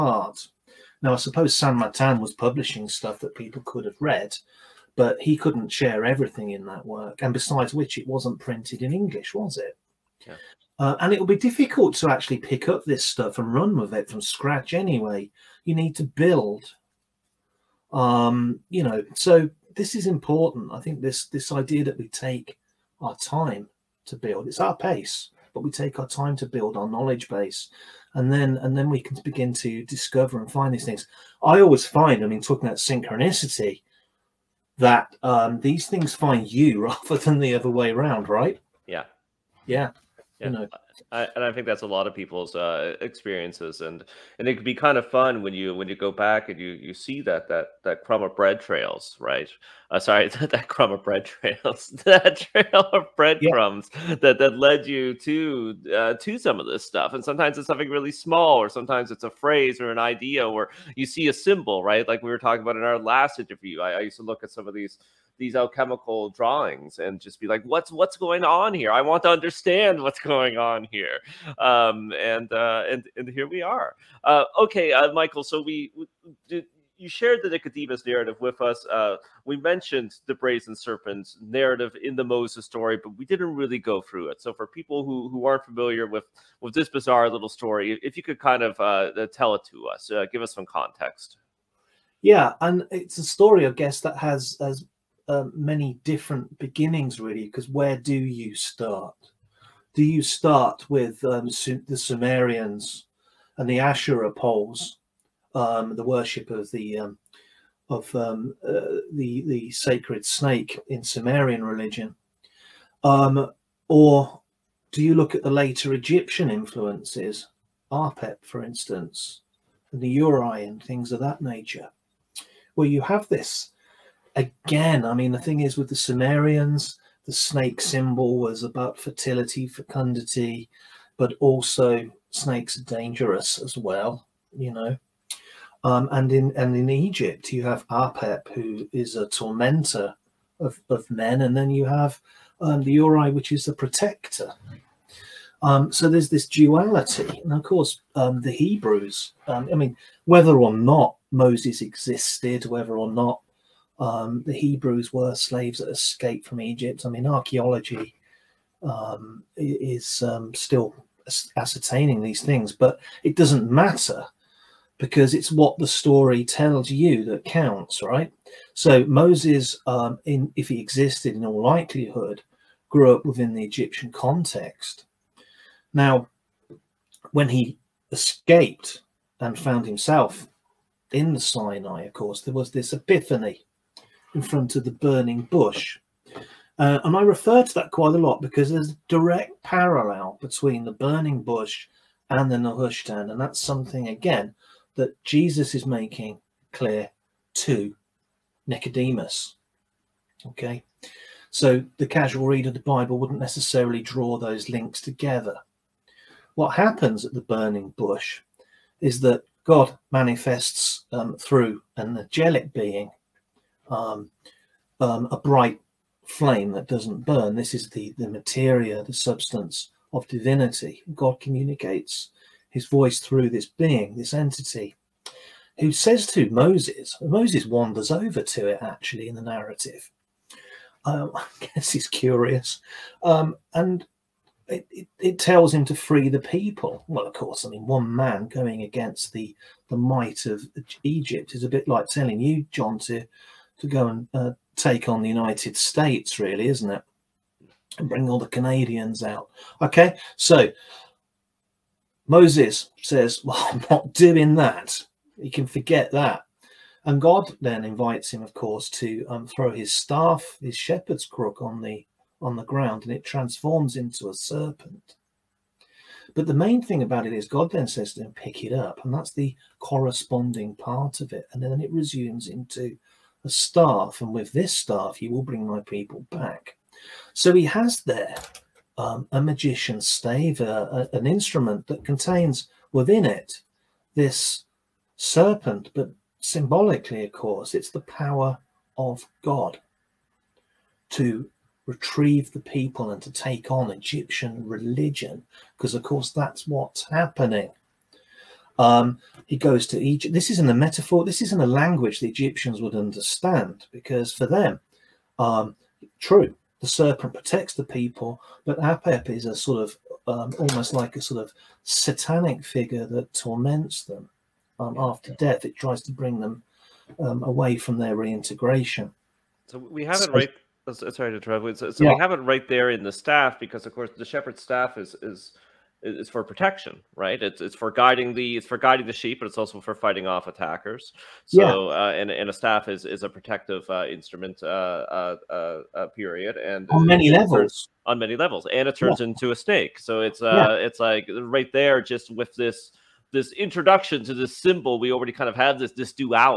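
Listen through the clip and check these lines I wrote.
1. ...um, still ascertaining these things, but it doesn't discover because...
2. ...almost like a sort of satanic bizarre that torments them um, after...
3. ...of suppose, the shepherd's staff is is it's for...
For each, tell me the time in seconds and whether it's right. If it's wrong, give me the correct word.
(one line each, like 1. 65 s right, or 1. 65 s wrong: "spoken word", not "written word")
1. 160 s wrong: "matter", not "discover"
2. 310 s wrong: "figure", not "bizarre"
3. 323 s wrong: "course", not "suppose".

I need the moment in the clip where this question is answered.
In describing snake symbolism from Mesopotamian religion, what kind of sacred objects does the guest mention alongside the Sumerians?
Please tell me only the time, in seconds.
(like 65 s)
103 s.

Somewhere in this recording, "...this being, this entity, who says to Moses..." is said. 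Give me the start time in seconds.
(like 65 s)
223 s.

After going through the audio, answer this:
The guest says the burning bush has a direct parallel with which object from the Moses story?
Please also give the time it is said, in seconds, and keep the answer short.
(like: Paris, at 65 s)
Nehushtan, at 192 s.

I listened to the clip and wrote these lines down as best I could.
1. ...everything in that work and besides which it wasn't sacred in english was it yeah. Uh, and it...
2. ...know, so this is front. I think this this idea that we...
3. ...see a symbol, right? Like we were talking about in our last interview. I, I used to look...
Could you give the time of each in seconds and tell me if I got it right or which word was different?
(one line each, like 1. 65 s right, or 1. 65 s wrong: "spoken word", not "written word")
1. 6 s wrong: "printed", not "sacred"
2. 18 s wrong: "important", not "front"
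3. 61 s right.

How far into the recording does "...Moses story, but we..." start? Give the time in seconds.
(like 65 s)
82 s.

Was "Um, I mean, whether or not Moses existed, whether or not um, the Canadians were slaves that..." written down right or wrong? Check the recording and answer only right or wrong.
wrong.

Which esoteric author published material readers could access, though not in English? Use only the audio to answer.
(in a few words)
Saint Martin.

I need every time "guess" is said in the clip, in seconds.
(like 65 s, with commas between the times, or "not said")
93 s, 231 s.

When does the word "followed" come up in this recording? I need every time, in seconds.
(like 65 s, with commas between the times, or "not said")
not said.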